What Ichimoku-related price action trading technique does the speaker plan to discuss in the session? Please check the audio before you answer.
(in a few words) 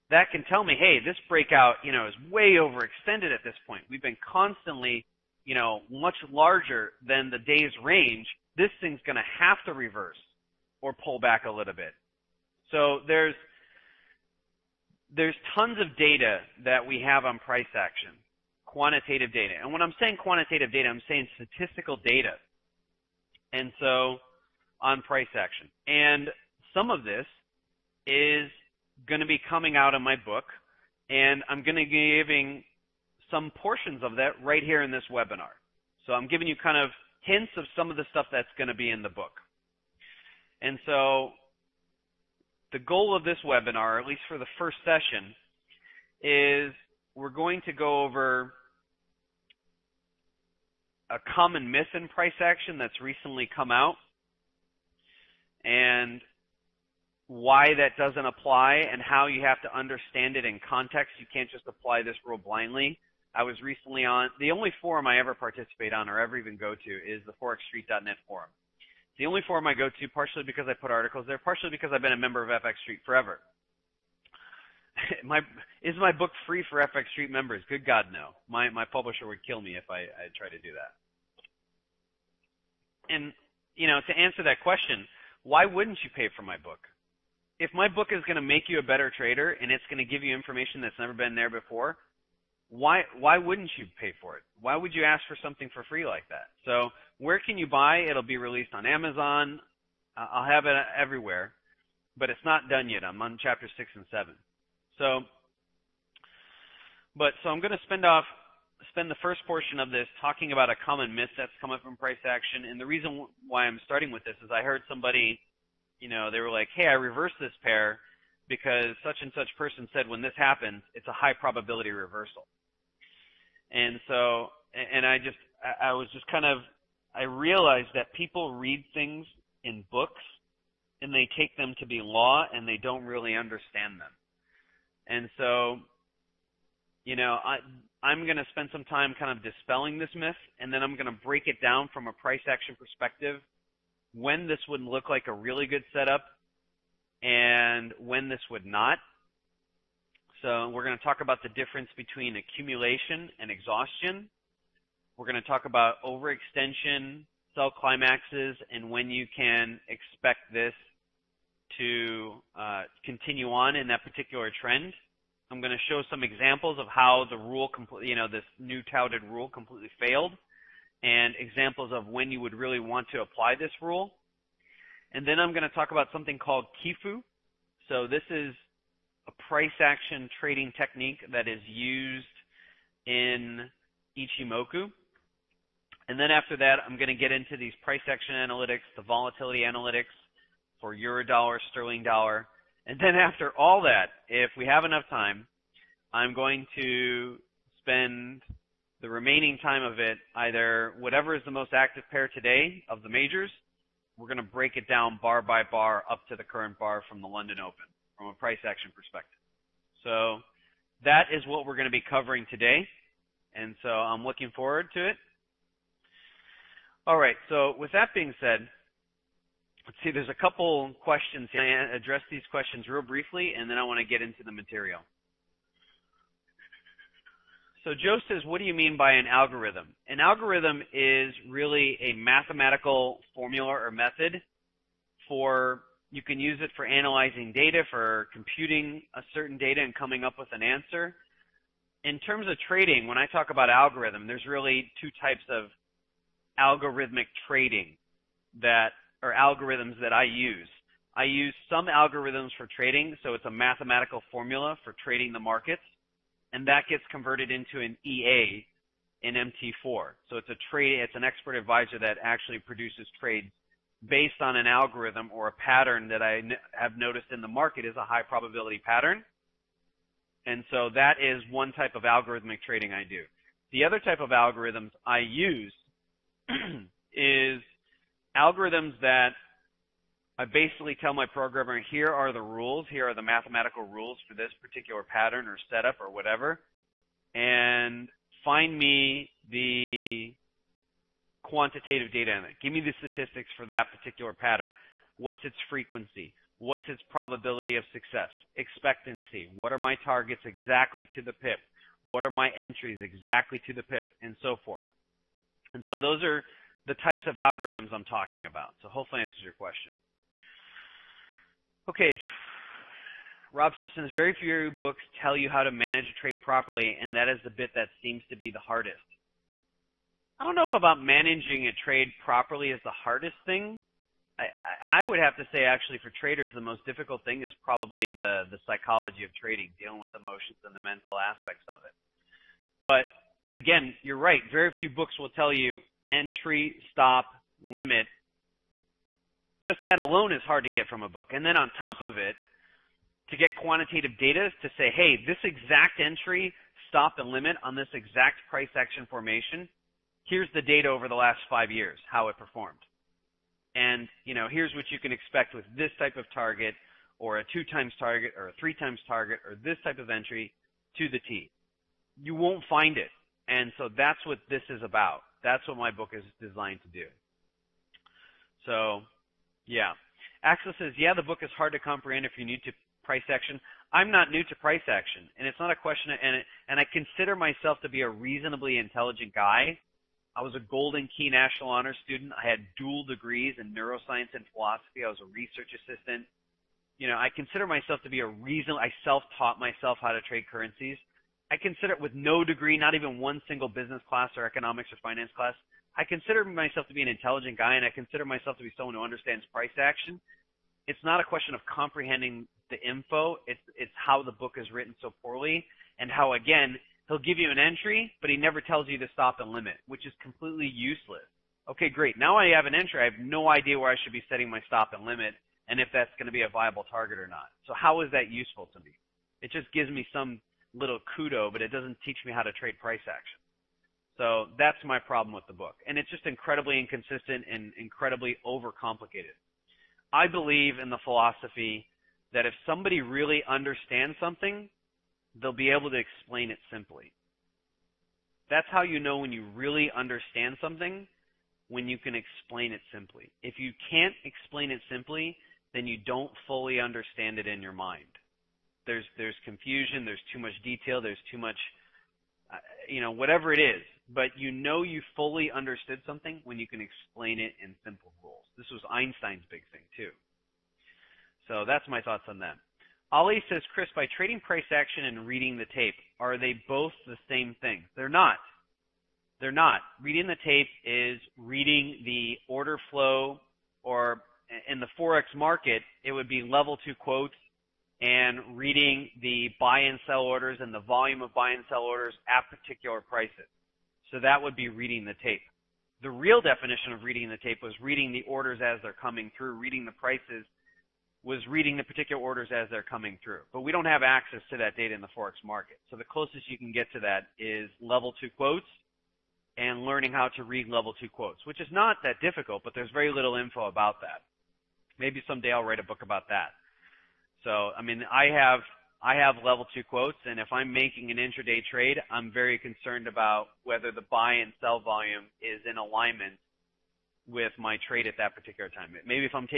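Kifu.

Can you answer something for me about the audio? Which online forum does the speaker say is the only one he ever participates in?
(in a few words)
forexstreet.net.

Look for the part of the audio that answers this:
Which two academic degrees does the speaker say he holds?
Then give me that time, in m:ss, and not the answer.
6:23.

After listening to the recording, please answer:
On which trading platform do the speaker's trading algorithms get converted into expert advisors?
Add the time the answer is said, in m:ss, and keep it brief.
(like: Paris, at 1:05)
MT4, at 4:19.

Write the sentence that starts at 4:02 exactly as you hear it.
In terms of trading, when I talk about algorithm, there's really two types of algorithmic trading that, or algorithms that I use.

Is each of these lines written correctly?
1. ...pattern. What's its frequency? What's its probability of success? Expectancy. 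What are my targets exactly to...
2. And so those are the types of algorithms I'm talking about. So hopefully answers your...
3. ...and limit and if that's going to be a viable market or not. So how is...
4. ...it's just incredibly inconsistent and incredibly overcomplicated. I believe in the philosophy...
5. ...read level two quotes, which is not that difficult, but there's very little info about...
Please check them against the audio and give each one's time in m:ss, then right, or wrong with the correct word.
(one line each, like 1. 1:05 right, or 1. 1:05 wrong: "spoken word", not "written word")
1. 4:54 right
2. 5:05 right
3. 6:54 wrong: "target", not "market"
4. 7:05 right
5. 8:20 right.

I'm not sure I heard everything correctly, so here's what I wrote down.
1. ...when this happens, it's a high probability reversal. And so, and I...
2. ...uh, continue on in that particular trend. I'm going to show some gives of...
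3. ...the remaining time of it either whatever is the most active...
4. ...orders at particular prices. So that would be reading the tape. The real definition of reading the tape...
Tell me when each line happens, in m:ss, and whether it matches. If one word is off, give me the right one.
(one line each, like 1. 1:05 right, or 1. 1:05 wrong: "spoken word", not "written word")
1. 2:00 right
2. 2:42 wrong: "examples", not "gives"
3. 3:19 right
4. 8:01 right.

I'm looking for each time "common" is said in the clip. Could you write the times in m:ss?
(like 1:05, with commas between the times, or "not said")
0:51, 1:50.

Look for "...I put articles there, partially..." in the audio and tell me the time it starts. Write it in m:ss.
1:10.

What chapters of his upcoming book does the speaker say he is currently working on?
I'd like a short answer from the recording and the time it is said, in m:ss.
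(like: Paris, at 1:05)
6 and 7, at 1:43.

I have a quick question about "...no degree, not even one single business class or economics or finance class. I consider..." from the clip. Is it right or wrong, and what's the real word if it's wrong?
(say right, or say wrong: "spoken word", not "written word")
right.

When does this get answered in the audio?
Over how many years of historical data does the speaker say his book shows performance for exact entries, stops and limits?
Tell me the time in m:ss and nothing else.
5:51.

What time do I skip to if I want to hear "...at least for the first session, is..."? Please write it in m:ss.
0:44.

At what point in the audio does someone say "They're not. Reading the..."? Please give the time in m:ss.
7:49.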